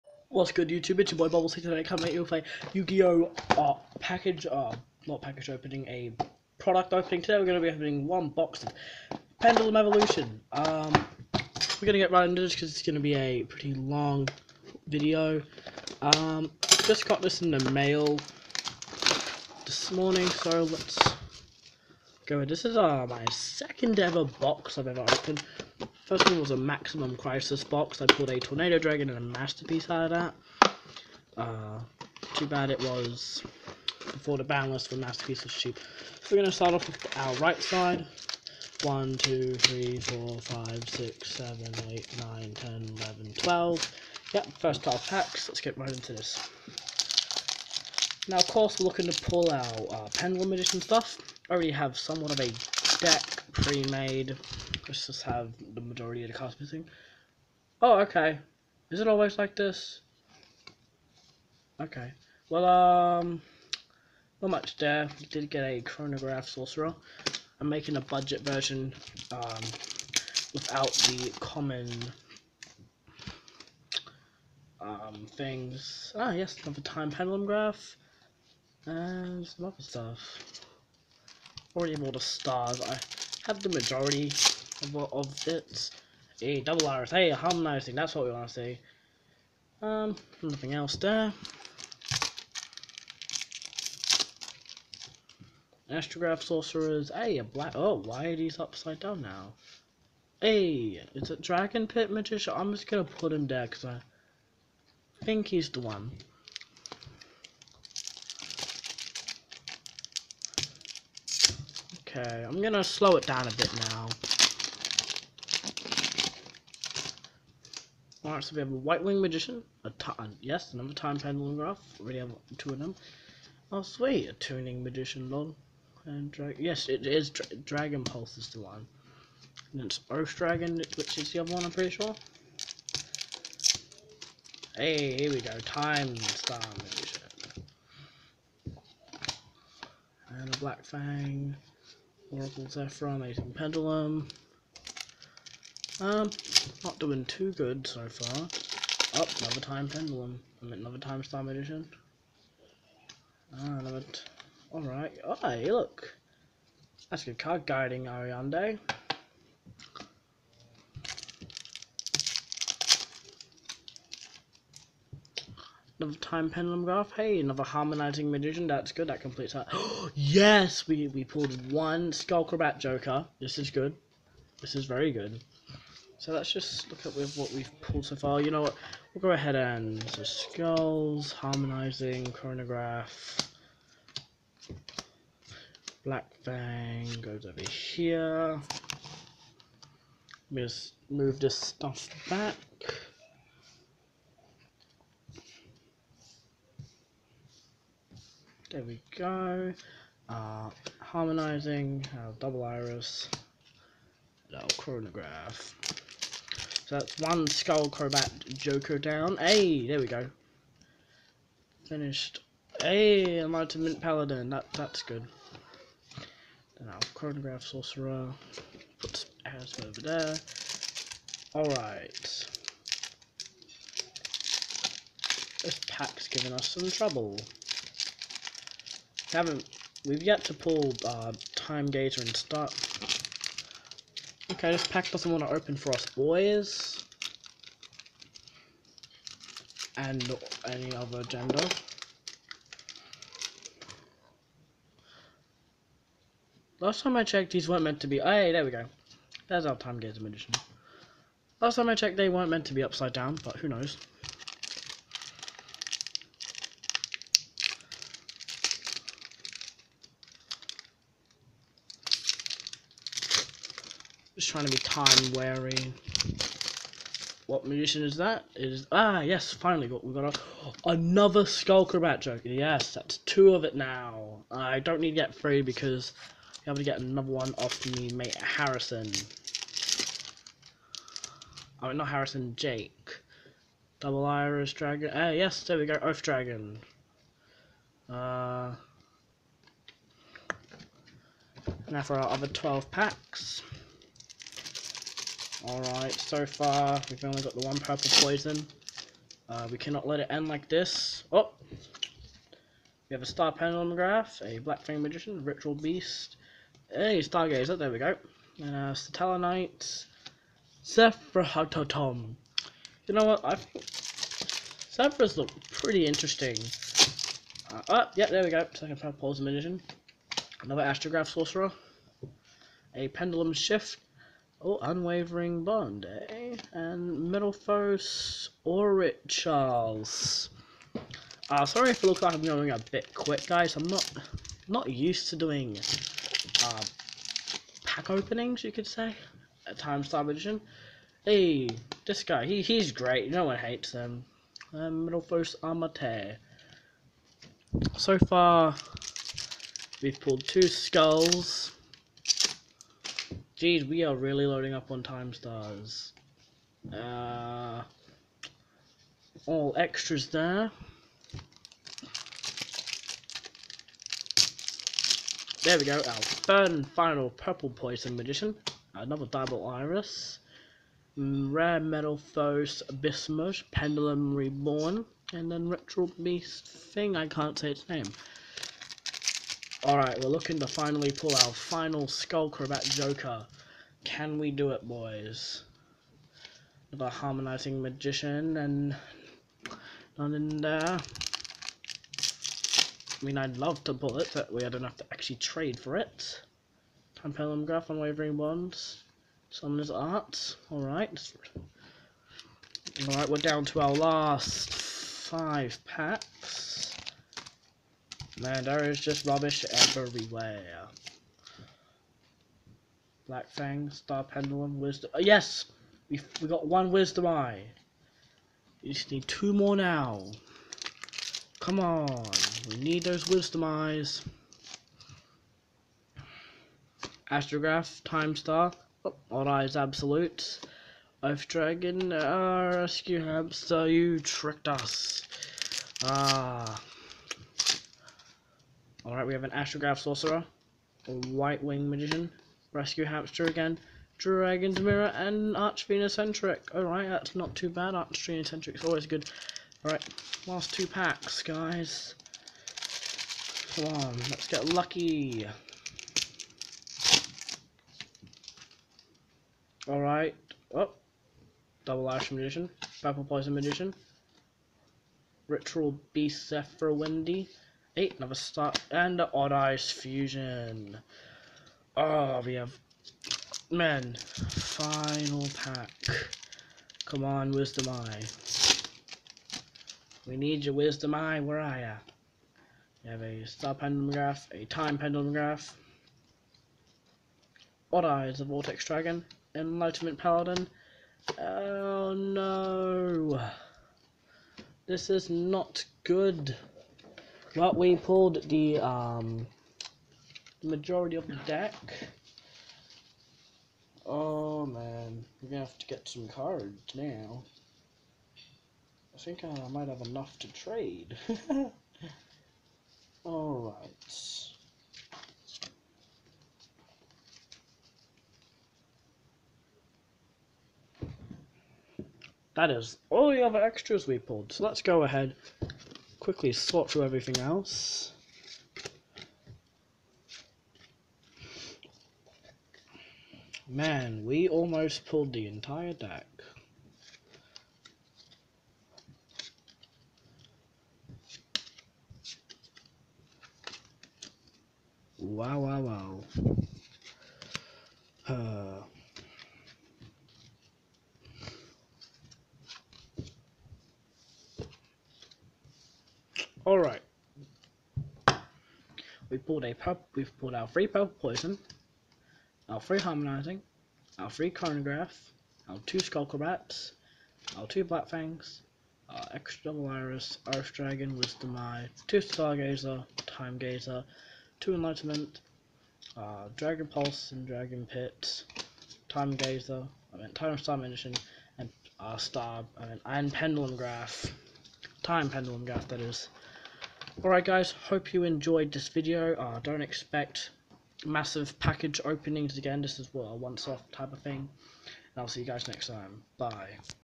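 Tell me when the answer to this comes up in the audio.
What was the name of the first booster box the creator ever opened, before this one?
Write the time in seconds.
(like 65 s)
26 s.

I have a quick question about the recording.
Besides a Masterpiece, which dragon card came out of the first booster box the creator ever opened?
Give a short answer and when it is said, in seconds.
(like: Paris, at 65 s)
Tornado Dragon, at 28 s.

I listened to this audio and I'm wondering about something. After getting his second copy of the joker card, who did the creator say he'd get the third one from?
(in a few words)
Jake.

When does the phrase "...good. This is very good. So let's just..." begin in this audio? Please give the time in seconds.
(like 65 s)
173 s.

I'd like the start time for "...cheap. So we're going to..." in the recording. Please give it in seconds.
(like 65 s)
35 s.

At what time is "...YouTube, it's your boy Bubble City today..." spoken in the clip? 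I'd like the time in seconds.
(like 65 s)
0 s.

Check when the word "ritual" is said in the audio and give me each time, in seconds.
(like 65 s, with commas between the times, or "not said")
305 s, 465 s.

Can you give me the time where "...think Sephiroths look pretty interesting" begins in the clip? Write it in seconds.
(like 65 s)
313 s.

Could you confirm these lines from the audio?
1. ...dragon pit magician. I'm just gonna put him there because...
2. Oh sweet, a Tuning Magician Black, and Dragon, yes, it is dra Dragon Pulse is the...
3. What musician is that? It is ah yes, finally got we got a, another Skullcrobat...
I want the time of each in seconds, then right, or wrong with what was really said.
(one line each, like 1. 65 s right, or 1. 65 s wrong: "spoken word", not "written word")
1. 101 s right
2. 123 s wrong: "Log", not "Black"
3. 267 s right.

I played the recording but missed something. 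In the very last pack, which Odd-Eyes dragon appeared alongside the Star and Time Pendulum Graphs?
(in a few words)
Vortex Dragon.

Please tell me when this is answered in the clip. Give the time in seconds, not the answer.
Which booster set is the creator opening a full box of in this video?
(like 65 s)
9 s.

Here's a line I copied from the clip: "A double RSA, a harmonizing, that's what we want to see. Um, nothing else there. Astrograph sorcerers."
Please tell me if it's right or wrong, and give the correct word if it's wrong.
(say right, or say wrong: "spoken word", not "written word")
right.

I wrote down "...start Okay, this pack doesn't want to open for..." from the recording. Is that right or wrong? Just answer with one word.
right.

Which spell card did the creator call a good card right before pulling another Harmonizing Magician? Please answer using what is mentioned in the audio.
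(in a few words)
Guiding Ariadne.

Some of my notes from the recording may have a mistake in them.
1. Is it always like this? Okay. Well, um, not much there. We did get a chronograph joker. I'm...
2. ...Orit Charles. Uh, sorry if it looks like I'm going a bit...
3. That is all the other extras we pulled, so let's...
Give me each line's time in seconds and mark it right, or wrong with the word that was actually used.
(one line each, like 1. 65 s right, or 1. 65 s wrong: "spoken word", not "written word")
1. 58 s wrong: "sorcerer", not "joker"
2. 328 s right
3. 522 s right.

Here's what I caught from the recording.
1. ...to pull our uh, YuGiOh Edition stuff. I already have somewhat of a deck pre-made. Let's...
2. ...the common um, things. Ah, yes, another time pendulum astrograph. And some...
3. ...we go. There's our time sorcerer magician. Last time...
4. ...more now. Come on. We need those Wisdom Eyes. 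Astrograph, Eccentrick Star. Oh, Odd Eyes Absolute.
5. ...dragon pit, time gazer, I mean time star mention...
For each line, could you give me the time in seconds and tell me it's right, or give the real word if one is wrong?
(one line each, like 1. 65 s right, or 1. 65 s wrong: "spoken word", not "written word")
1. 49 s wrong: "Pendulum", not "YuGiOh"
2. 71 s wrong: "graph", not "astrograph"
3. 248 s wrong: "gazer", not "sorcerer"
4. 419 s wrong: "Time", not "Eccentrick"
5. 577 s right.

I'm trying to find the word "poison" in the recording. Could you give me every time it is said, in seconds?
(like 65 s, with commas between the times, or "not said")
298 s, 319 s, 367 s, 463 s, 561 s.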